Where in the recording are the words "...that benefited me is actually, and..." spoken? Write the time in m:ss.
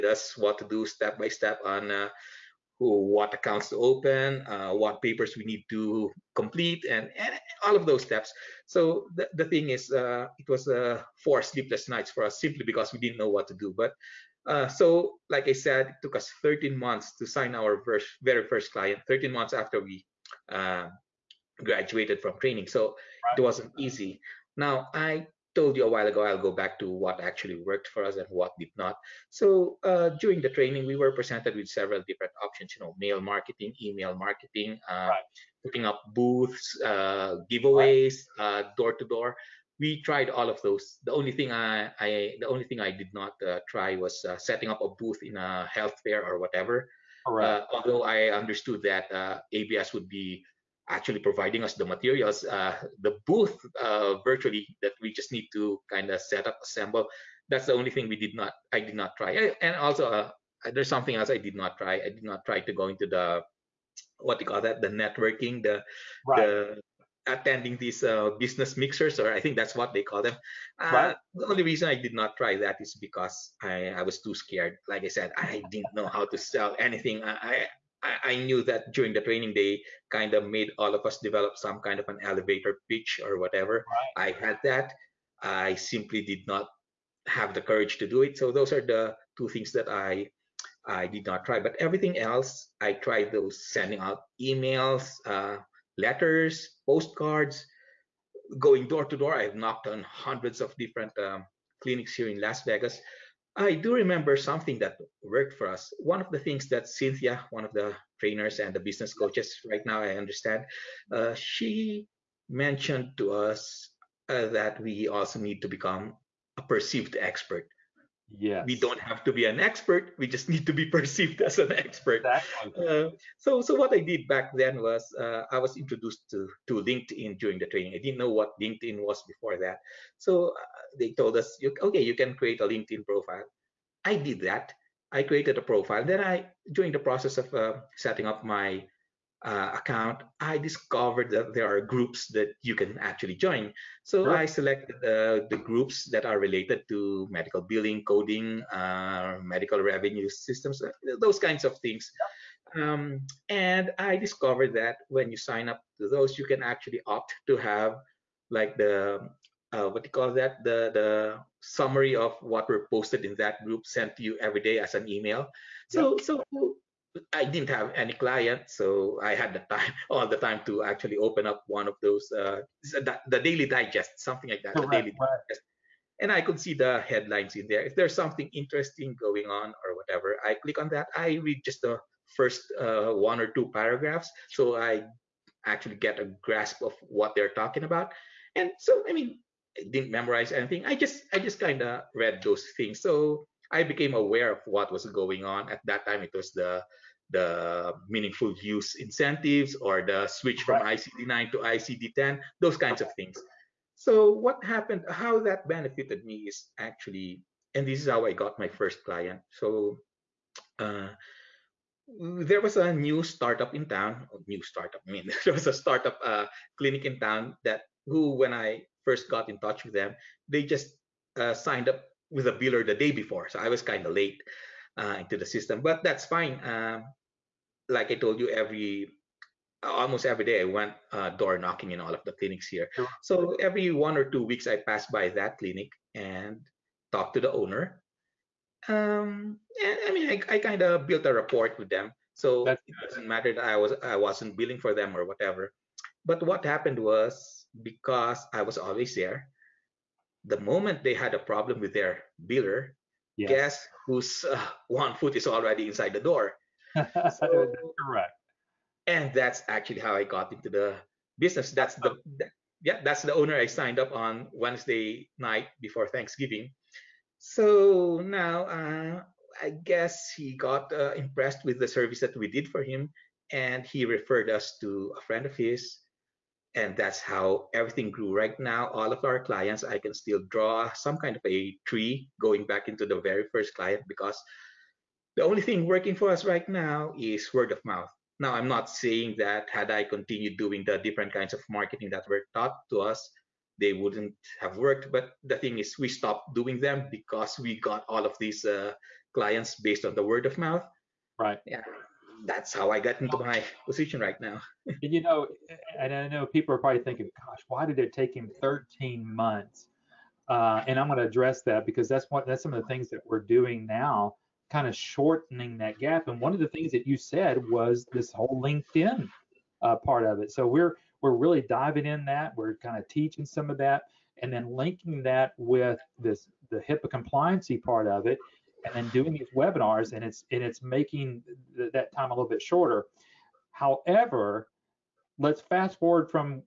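3:25.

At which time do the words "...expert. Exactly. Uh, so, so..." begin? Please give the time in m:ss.
2:01.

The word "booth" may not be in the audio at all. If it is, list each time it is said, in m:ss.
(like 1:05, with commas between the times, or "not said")
0:36, 0:44, 0:53.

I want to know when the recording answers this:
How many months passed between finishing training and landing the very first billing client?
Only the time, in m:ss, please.
0:16.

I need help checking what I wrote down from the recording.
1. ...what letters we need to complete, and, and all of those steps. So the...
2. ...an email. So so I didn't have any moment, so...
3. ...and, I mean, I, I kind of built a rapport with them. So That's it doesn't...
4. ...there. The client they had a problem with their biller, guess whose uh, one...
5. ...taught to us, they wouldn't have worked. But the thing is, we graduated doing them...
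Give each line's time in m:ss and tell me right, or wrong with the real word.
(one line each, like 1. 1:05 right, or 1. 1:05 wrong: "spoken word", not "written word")
1. 0:04 wrong: "papers", not "letters"
2. 2:44 wrong: "client", not "moment"
3. 3:59 right
4. 4:09 wrong: "moment", not "client"
5. 4:52 wrong: "stopped", not "graduated".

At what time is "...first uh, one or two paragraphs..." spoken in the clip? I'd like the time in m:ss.
3:02.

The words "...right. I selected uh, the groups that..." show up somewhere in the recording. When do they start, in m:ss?
2:24.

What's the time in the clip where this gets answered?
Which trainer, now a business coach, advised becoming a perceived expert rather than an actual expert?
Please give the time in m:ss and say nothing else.
1:46.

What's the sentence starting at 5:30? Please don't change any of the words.
And it's and it's making th- that time a little bit shorter.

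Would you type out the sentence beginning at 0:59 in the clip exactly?
I, and also, uh, there's something else I did not try.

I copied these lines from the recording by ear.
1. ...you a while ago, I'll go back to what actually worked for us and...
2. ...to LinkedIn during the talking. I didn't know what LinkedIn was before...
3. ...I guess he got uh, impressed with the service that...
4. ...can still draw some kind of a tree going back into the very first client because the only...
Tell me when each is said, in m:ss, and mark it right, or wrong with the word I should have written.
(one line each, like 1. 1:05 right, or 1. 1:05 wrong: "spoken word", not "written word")
1. 0:25 right
2. 2:06 wrong: "training", not "talking"
3. 4:29 right
4. 4:39 right.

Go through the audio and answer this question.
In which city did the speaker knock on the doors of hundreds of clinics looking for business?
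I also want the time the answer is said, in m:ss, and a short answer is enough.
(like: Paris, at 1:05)
Las Vegas, at 1:42.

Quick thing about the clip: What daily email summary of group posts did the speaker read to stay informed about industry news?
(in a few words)
Daily Digest.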